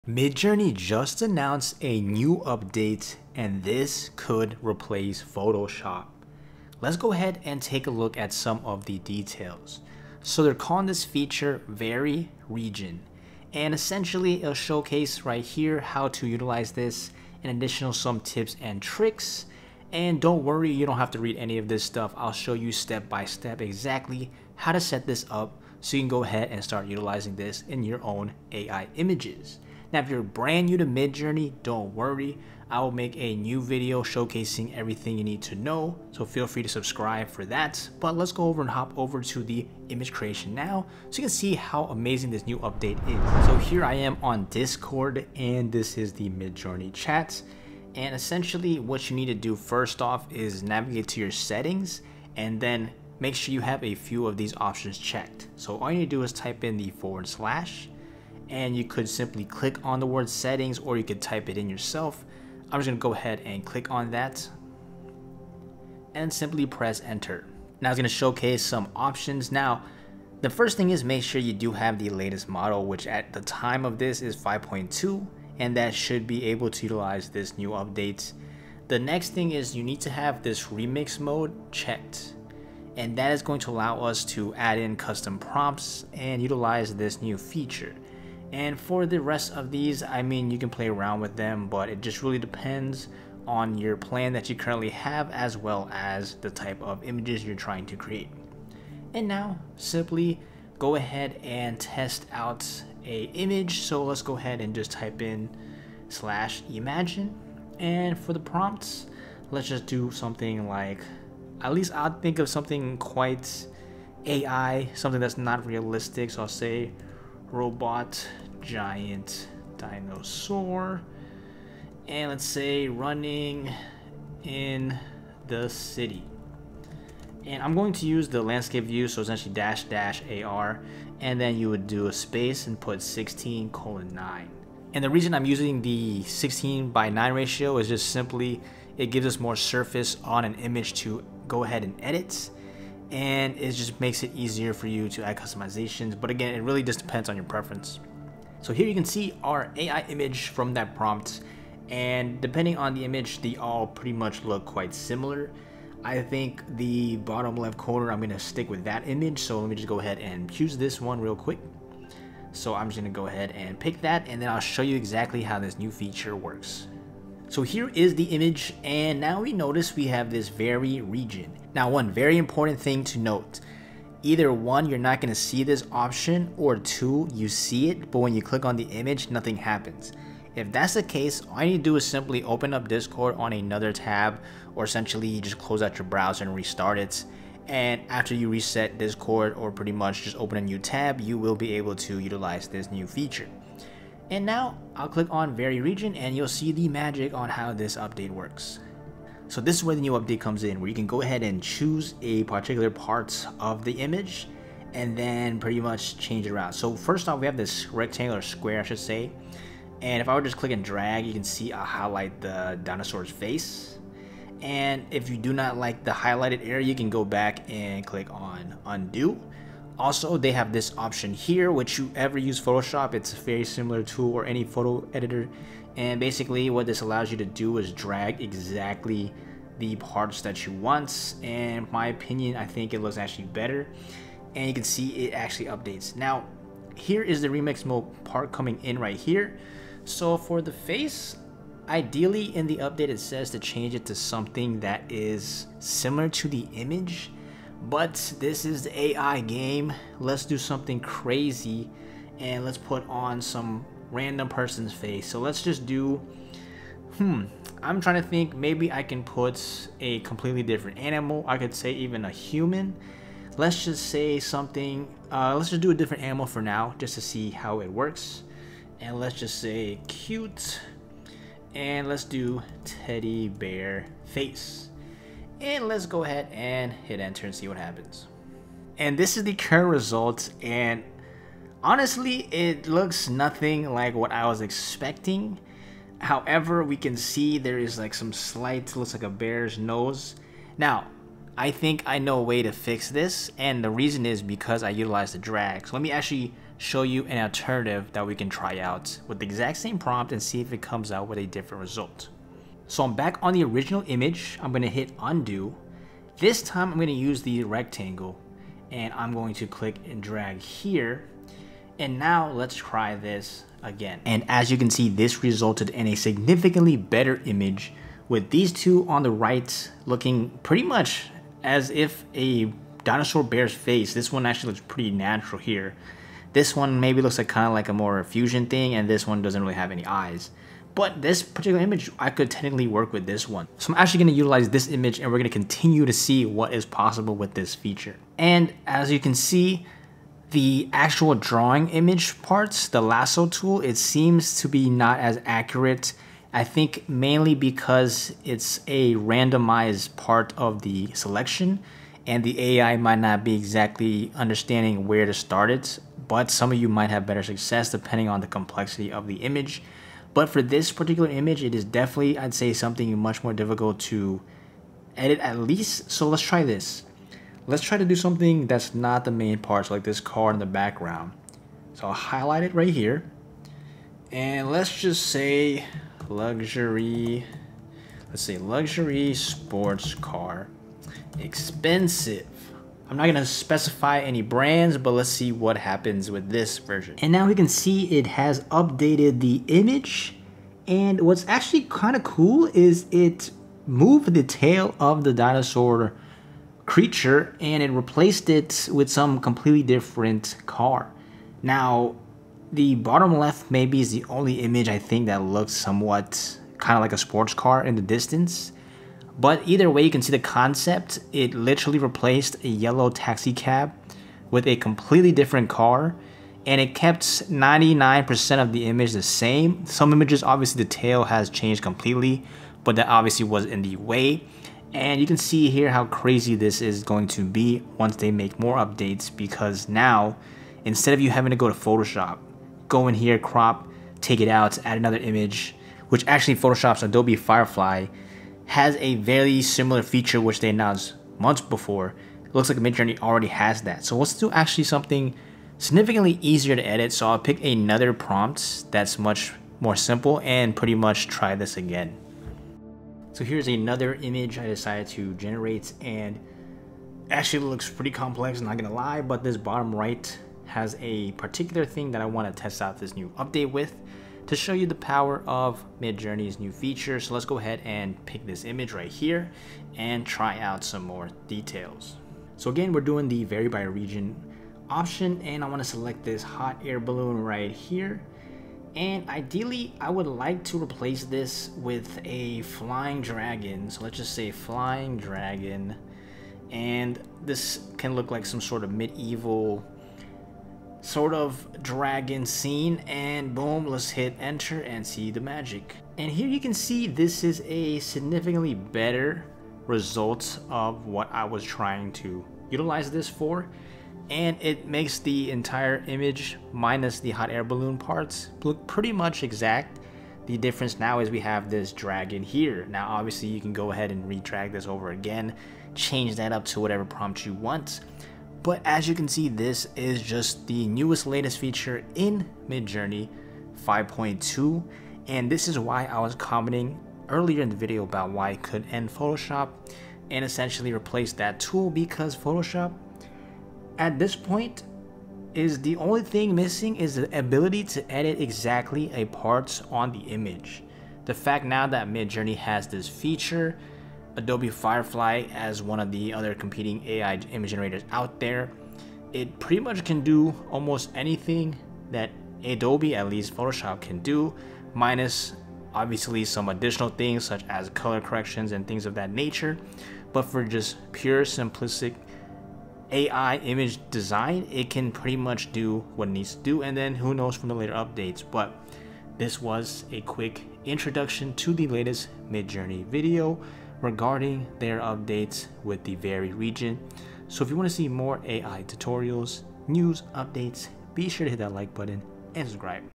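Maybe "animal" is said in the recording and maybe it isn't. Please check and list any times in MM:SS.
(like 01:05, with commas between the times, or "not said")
04:20, 04:26.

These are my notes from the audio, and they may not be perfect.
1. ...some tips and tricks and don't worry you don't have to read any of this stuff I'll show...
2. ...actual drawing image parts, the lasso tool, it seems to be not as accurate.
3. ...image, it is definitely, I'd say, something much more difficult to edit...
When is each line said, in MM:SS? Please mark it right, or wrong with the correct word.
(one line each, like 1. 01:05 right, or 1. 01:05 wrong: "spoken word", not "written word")
1. 00:17 right
2. 05:40 right
3. 06:01 right.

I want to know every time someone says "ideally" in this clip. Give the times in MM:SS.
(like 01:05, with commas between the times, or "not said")
04:01, 07:59.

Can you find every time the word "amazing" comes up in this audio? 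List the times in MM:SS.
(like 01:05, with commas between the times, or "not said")
00:41.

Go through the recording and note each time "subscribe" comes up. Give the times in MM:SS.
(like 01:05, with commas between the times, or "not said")
00:36, 09:42.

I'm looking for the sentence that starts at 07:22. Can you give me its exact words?
It looks like Midjourney already has that.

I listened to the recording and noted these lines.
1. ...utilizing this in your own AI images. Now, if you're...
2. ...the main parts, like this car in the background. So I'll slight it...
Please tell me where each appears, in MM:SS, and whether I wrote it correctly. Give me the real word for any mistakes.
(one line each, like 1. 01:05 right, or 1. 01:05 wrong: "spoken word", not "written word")
1. 00:26 right
2. 06:09 wrong: "highlight", not "slight".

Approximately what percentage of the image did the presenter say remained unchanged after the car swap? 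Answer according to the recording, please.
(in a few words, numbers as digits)
99%.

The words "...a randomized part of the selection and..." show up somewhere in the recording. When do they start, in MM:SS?
05:48.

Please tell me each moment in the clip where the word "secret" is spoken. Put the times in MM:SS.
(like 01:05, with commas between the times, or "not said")
not said.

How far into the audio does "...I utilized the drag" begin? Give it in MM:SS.
04:54.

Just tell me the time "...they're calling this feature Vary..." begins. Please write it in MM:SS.
00:10.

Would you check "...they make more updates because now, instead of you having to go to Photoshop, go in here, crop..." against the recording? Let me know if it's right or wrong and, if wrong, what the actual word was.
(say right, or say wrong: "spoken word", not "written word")
right.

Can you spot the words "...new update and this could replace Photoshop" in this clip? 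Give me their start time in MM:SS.
00:02.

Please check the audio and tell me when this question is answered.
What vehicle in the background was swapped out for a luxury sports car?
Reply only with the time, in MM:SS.
06:52.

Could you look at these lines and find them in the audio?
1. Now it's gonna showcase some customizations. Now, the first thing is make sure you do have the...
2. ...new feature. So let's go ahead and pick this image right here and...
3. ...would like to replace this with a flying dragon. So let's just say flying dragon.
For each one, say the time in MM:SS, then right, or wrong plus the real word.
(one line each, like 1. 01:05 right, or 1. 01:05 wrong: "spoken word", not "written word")
1. 01:07 wrong: "options", not "customizations"
2. 07:46 right
3. 08:00 right.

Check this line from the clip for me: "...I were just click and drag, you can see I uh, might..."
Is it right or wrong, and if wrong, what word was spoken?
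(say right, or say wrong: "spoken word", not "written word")
wrong: "highlight", not "might".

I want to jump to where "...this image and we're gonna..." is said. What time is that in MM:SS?
05:34.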